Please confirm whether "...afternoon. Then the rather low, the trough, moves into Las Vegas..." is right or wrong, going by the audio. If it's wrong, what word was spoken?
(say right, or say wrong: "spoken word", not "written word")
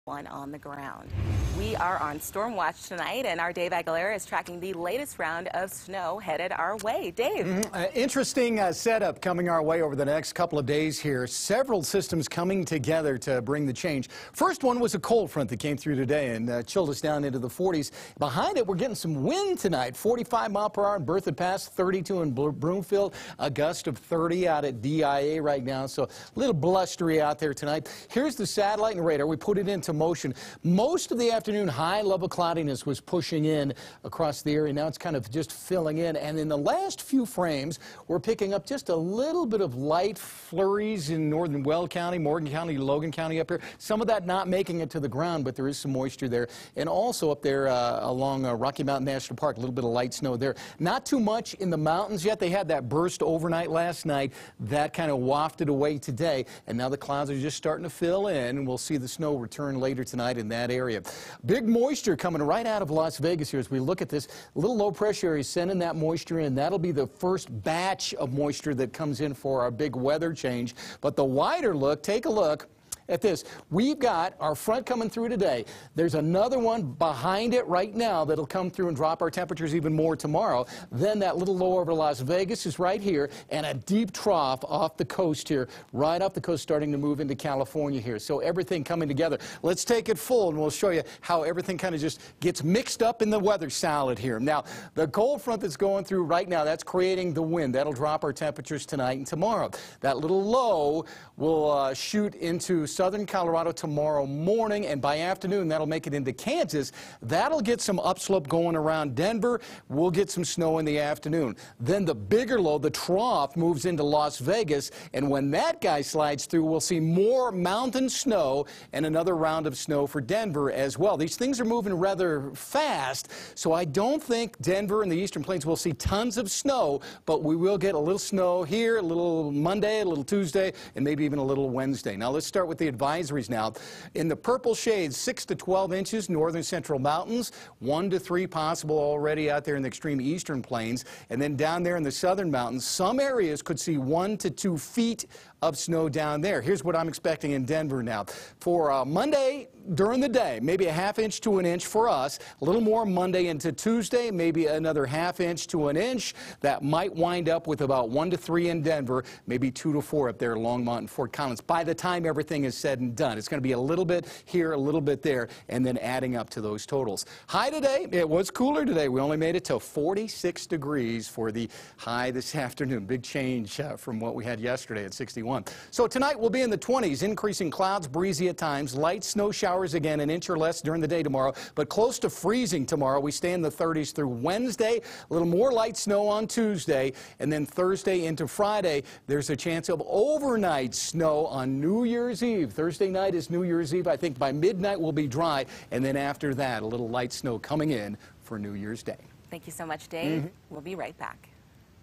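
wrong: "bigger", not "rather".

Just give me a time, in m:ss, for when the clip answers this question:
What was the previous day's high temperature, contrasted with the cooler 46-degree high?
2:55.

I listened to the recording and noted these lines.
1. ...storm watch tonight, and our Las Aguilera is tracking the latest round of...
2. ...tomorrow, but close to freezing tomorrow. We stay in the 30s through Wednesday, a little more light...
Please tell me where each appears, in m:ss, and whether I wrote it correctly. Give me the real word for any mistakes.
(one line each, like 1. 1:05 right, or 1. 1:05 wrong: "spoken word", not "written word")
1. 0:02 wrong: "Dave", not "Las"
2. 3:01 right.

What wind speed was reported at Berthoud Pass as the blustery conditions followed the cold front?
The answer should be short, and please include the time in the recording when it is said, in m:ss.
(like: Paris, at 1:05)
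45 mph, at 0:19.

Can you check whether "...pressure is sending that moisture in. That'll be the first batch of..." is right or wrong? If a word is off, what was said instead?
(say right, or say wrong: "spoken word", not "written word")
right.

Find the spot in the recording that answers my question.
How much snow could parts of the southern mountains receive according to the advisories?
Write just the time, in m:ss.
2:23.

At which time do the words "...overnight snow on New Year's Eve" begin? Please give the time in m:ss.
3:10.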